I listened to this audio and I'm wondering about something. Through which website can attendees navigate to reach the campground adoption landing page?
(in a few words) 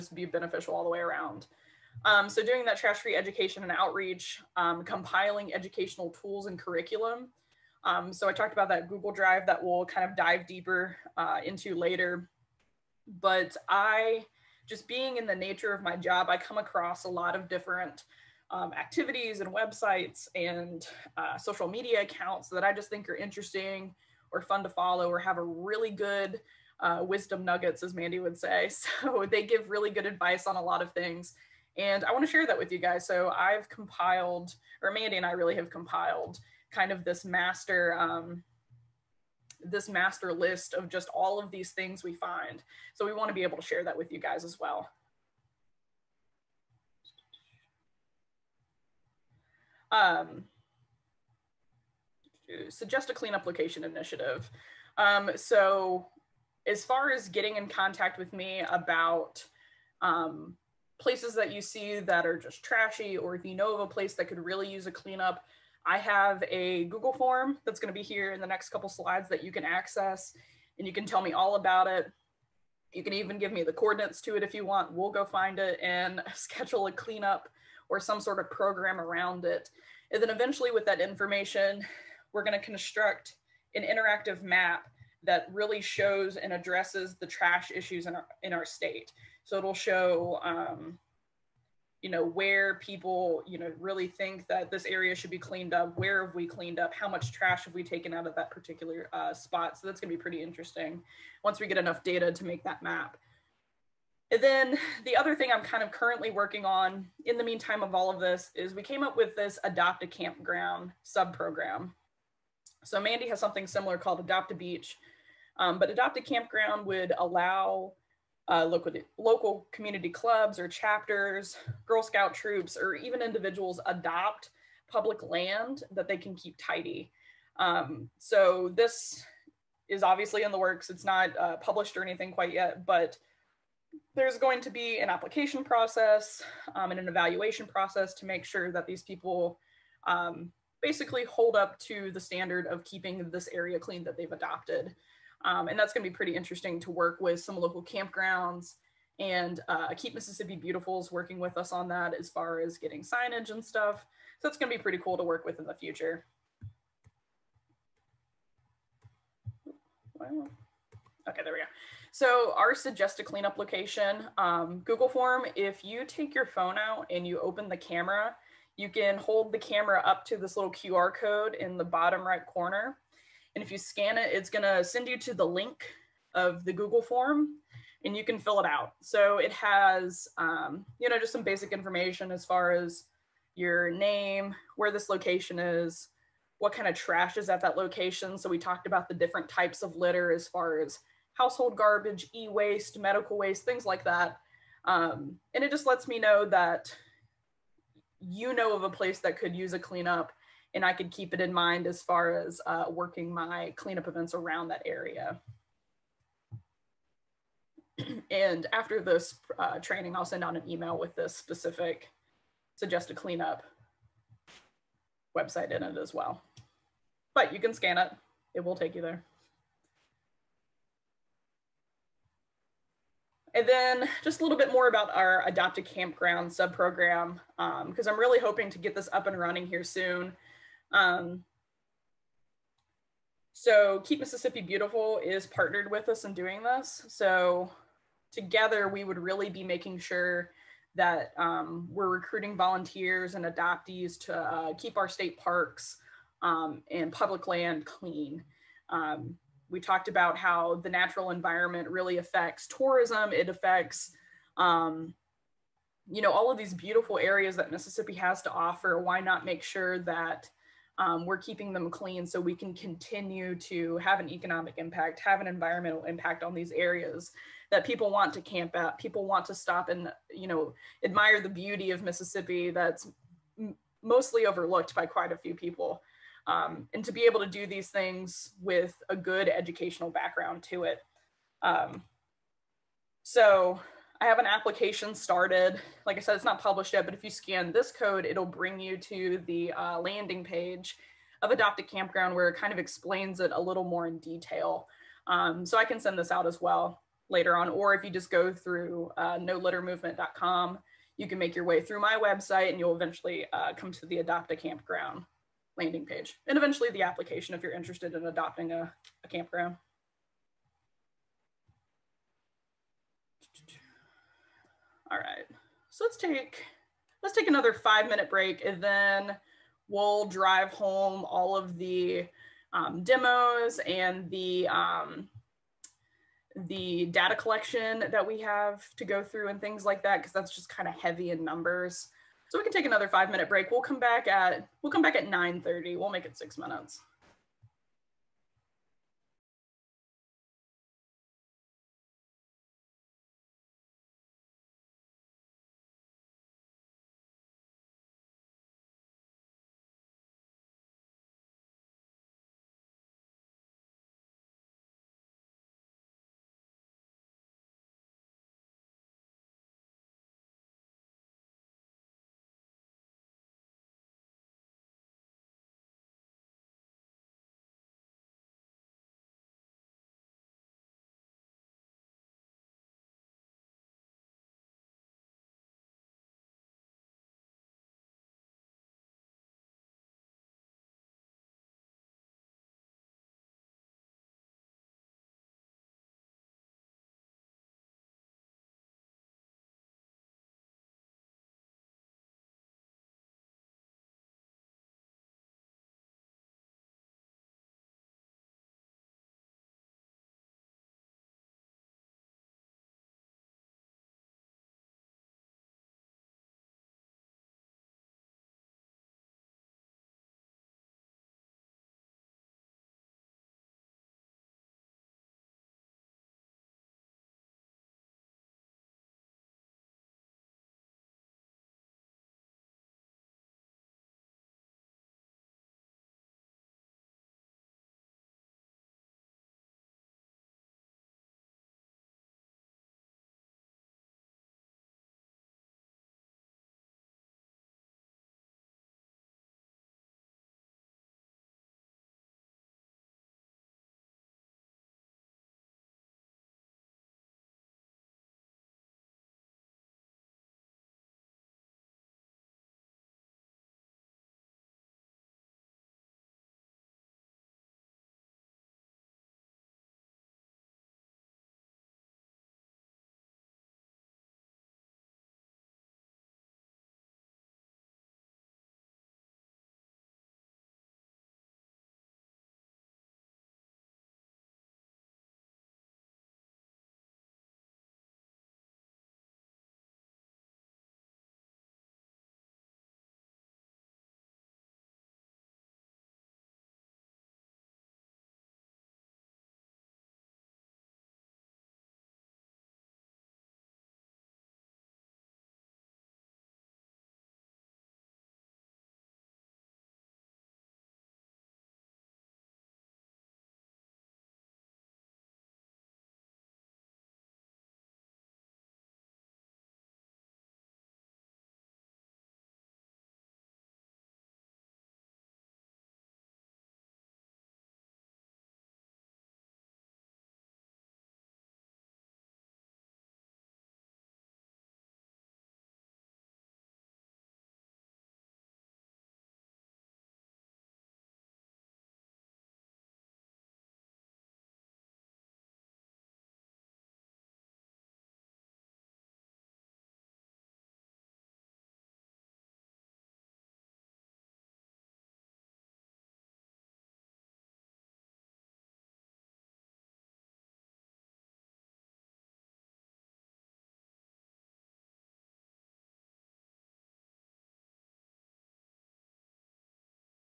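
noLitterMovement.com.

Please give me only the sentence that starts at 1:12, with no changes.
You can even give me the coordinates to it if you want.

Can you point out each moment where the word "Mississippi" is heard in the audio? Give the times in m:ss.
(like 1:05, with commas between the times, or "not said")
2:30, 3:54, 4:17, 4:32.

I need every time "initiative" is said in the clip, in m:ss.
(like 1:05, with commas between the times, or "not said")
0:53.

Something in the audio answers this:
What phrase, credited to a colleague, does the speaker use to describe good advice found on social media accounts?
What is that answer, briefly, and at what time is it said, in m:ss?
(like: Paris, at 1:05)
wisdom nuggets, at 0:27.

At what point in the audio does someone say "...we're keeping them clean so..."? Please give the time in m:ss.
4:21.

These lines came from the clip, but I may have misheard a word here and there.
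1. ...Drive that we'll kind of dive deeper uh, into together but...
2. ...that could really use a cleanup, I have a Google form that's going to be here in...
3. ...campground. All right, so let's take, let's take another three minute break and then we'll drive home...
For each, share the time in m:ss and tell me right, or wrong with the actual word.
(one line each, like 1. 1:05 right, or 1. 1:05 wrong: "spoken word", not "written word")
1. 0:09 wrong: "later", not "together"
2. 1:04 right
3. 5:09 wrong: "five", not "three".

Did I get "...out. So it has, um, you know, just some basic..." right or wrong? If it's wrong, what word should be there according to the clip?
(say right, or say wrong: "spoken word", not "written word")
right.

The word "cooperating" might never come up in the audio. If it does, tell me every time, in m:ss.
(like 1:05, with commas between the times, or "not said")
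not said.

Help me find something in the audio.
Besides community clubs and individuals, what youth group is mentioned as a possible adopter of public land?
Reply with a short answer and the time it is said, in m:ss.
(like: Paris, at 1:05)
Girl Scout troops, at 2:01.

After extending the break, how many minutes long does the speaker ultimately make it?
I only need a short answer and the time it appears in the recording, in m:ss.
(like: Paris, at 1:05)
6, at 5:36.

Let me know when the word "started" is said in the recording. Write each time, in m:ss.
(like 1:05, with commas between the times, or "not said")
4:45.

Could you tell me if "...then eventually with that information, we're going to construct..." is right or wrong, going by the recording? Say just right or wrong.
right.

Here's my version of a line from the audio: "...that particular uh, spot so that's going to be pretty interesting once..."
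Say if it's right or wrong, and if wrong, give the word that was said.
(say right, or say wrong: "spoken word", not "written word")
right.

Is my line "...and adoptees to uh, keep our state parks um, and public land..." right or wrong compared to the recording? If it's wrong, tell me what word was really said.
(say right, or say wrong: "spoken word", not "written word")
right.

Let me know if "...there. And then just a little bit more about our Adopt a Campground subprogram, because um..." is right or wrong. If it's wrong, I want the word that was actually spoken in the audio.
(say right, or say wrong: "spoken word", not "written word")
right.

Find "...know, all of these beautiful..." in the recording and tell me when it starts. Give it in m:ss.
4:16.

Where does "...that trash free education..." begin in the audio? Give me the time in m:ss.
0:02.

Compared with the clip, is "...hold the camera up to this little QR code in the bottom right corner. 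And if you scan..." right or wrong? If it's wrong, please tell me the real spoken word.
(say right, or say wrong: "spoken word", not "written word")
right.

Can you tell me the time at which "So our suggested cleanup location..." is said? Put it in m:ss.
2:42.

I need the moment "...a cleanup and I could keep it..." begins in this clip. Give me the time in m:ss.
3:19.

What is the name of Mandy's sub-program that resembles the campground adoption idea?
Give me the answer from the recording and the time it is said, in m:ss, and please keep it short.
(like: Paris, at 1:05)
Adopt a Beach, at 1:54.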